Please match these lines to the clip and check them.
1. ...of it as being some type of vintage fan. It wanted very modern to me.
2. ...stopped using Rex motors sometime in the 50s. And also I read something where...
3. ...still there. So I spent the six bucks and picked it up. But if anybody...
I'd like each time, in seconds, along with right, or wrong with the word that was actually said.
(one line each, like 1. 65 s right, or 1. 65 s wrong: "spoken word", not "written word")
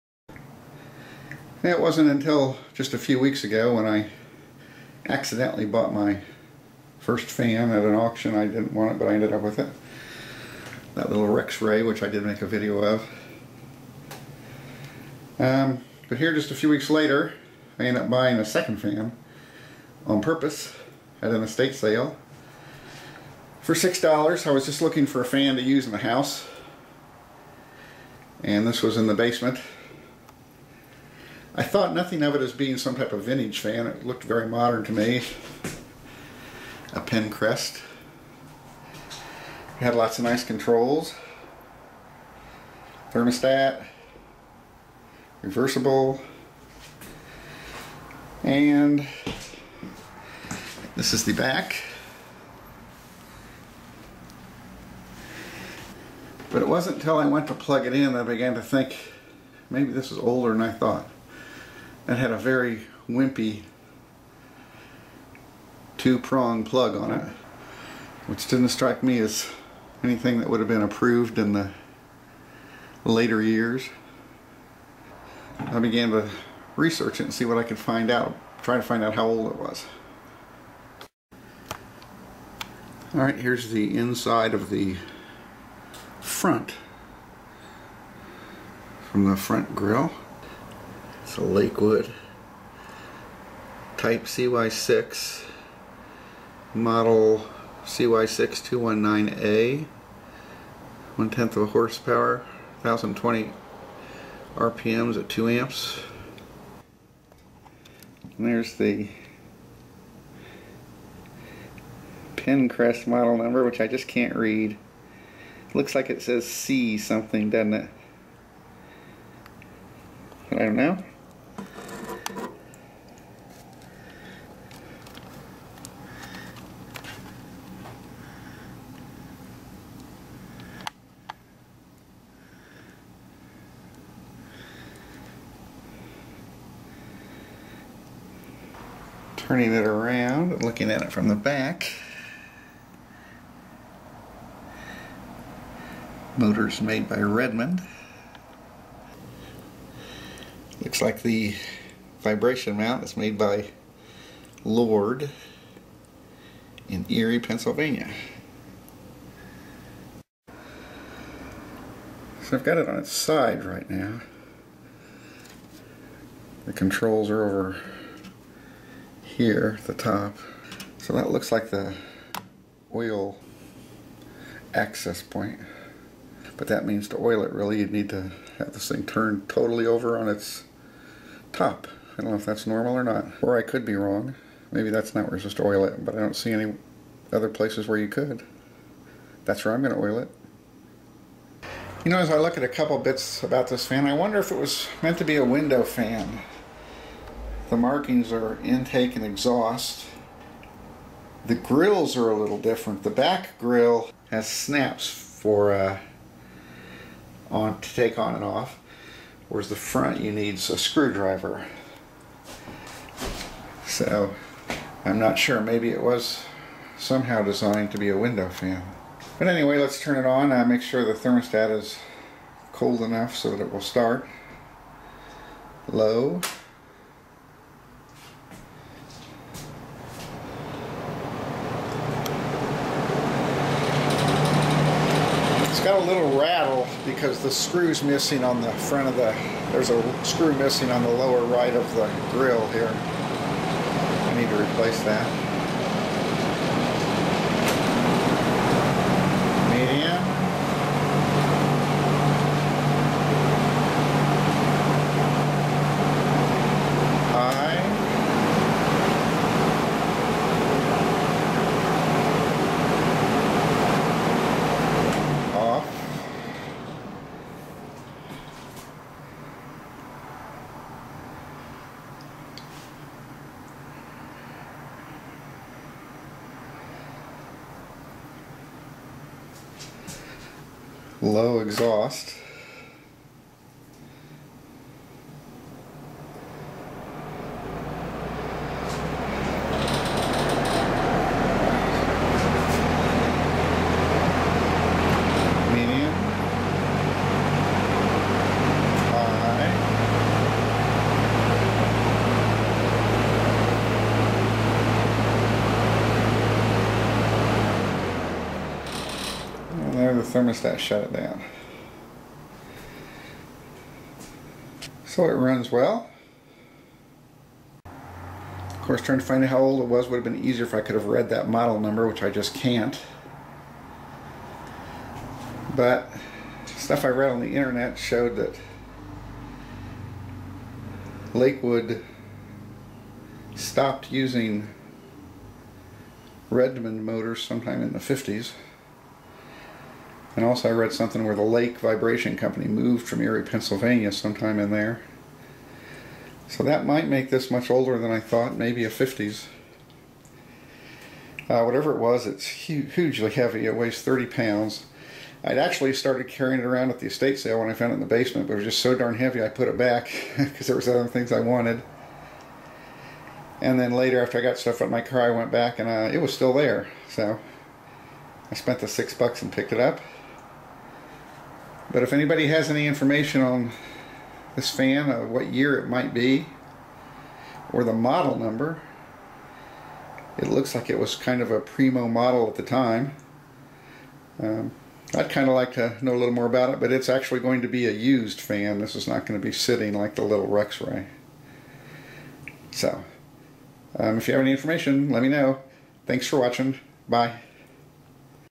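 1. 32 s wrong: "looked", not "wanted"
2. 333 s wrong: "Redmond", not "Rex"
3. 366 s right.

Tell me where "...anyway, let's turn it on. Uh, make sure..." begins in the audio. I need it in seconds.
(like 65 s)
219 s.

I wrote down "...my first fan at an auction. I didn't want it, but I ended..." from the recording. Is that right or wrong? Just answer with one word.
right.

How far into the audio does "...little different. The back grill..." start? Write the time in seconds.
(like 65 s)
202 s.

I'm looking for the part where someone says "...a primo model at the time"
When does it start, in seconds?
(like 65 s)
381 s.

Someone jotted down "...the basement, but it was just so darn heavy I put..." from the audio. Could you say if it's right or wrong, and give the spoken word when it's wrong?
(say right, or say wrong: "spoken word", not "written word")
right.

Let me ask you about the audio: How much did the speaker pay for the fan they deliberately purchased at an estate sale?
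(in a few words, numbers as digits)
$6.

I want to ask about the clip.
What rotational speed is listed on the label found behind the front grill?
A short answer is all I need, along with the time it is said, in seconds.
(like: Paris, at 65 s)
1020 RPM, at 102 s.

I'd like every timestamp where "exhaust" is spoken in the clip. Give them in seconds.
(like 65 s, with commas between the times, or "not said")
199 s, 281 s.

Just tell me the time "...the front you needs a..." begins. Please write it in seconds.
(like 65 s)
209 s.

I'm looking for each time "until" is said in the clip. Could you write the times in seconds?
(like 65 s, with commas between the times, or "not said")
2 s, 56 s.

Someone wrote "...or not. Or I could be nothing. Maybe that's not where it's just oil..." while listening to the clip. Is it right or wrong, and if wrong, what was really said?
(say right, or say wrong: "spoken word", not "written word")
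wrong: "wrong", not "nothing".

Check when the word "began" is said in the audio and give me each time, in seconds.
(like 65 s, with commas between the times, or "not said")
58 s, 75 s.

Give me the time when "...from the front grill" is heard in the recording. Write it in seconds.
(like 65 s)
89 s.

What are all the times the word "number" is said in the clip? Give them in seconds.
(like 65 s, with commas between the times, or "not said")
113 s, 321 s, 378 s.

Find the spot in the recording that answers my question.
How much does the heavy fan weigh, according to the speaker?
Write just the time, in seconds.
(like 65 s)
354 s.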